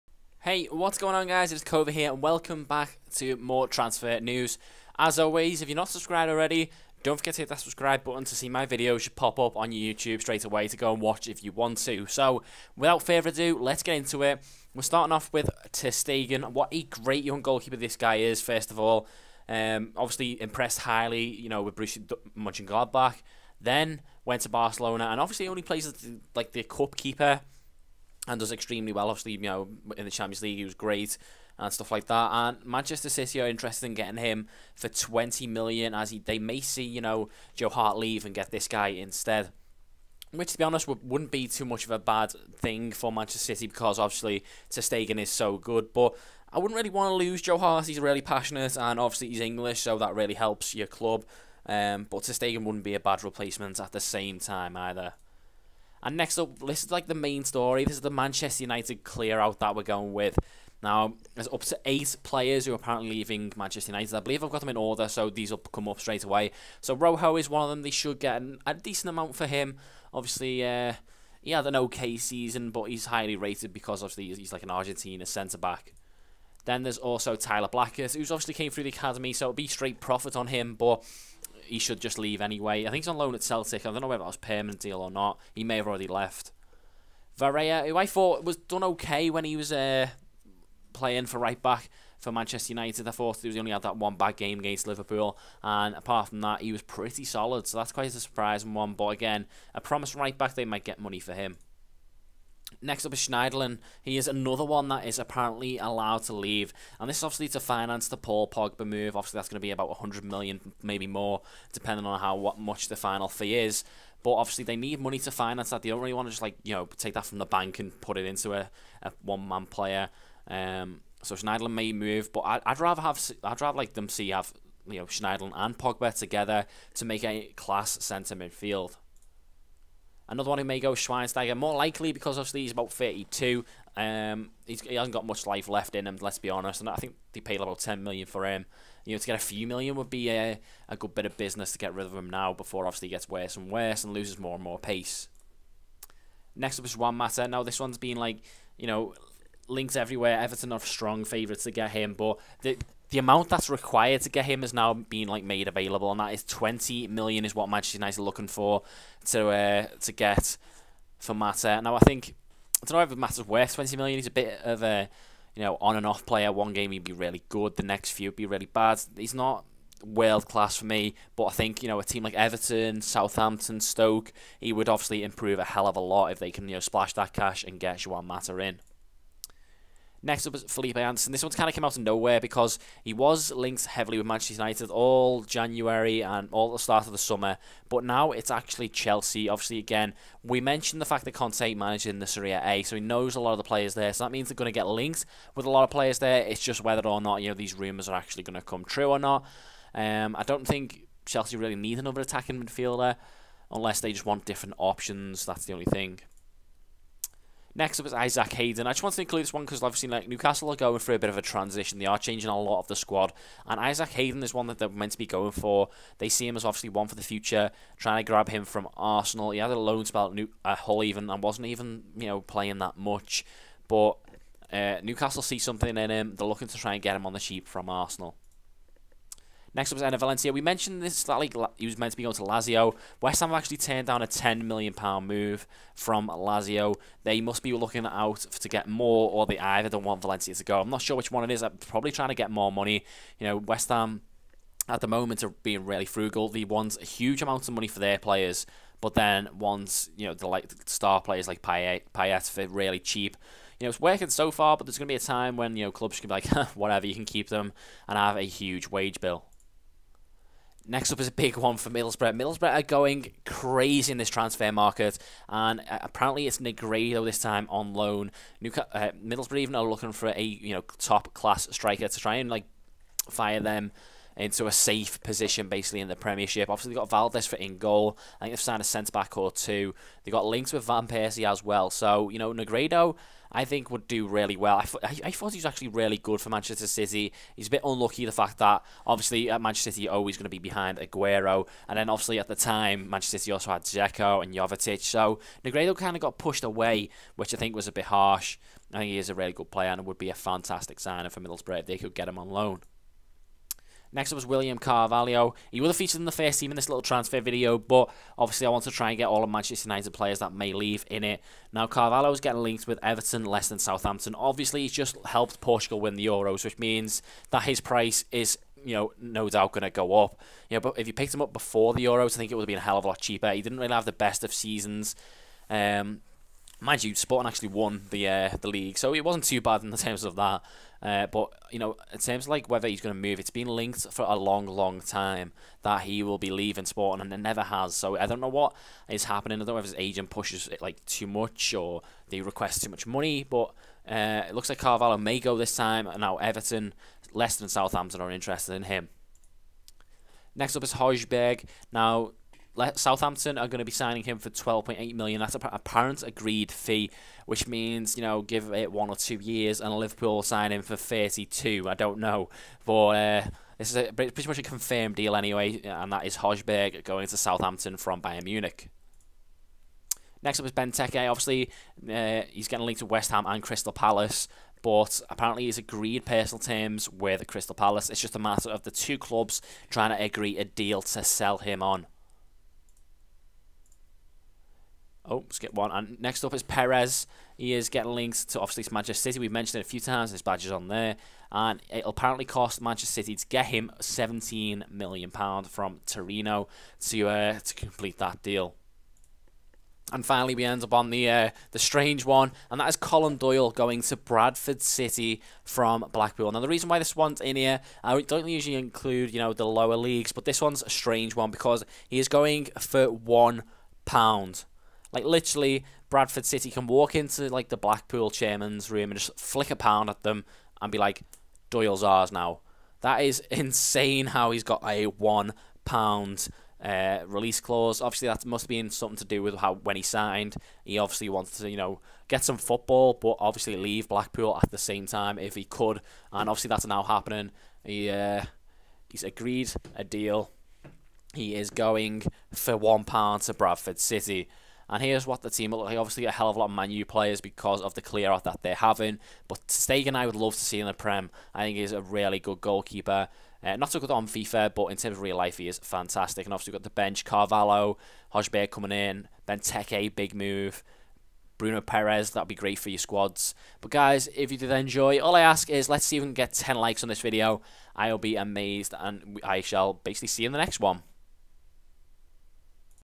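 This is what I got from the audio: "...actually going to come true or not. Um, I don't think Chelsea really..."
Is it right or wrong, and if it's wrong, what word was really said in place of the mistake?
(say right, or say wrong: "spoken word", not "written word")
right.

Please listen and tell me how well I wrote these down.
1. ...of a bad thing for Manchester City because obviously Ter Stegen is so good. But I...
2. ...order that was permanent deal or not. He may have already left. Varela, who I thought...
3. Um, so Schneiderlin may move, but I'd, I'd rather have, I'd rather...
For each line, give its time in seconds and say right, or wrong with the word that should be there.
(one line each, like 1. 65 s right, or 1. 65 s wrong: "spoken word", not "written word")
1. 41 s right
2. 84 s wrong: "whether", not "order"
3. 120 s right.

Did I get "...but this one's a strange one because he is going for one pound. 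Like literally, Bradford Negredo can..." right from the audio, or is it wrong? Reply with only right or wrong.
wrong.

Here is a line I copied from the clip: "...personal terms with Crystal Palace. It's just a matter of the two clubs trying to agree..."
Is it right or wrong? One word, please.
right.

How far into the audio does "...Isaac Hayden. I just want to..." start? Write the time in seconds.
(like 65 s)
208 s.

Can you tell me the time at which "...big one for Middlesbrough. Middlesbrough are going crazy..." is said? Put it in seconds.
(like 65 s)
261 s.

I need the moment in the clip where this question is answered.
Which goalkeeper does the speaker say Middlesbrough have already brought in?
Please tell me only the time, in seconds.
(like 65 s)
277 s.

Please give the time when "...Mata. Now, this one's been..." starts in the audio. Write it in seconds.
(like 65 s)
147 s.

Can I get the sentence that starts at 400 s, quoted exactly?
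And finally, we end up on the uh, the strange one, and that is Colin Doyle going to Bradford City from Blackpool.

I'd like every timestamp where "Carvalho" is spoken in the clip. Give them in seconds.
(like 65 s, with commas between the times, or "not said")
304 s, 311 s, 344 s, 457 s.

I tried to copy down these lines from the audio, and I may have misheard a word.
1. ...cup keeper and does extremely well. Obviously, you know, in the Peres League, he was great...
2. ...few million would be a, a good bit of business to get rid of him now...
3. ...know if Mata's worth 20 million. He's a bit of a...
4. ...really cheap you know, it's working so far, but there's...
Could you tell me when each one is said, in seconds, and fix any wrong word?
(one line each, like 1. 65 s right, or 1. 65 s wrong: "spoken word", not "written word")
1. 26 s wrong: "Champions", not "Peres"
2. 139 s right
3. 162 s right
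4. 252 s right.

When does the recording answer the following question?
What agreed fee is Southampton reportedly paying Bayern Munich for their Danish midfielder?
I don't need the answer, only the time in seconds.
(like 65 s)
354 s.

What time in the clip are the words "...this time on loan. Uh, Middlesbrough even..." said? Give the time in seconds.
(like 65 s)
267 s.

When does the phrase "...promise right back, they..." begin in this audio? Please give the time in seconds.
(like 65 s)
99 s.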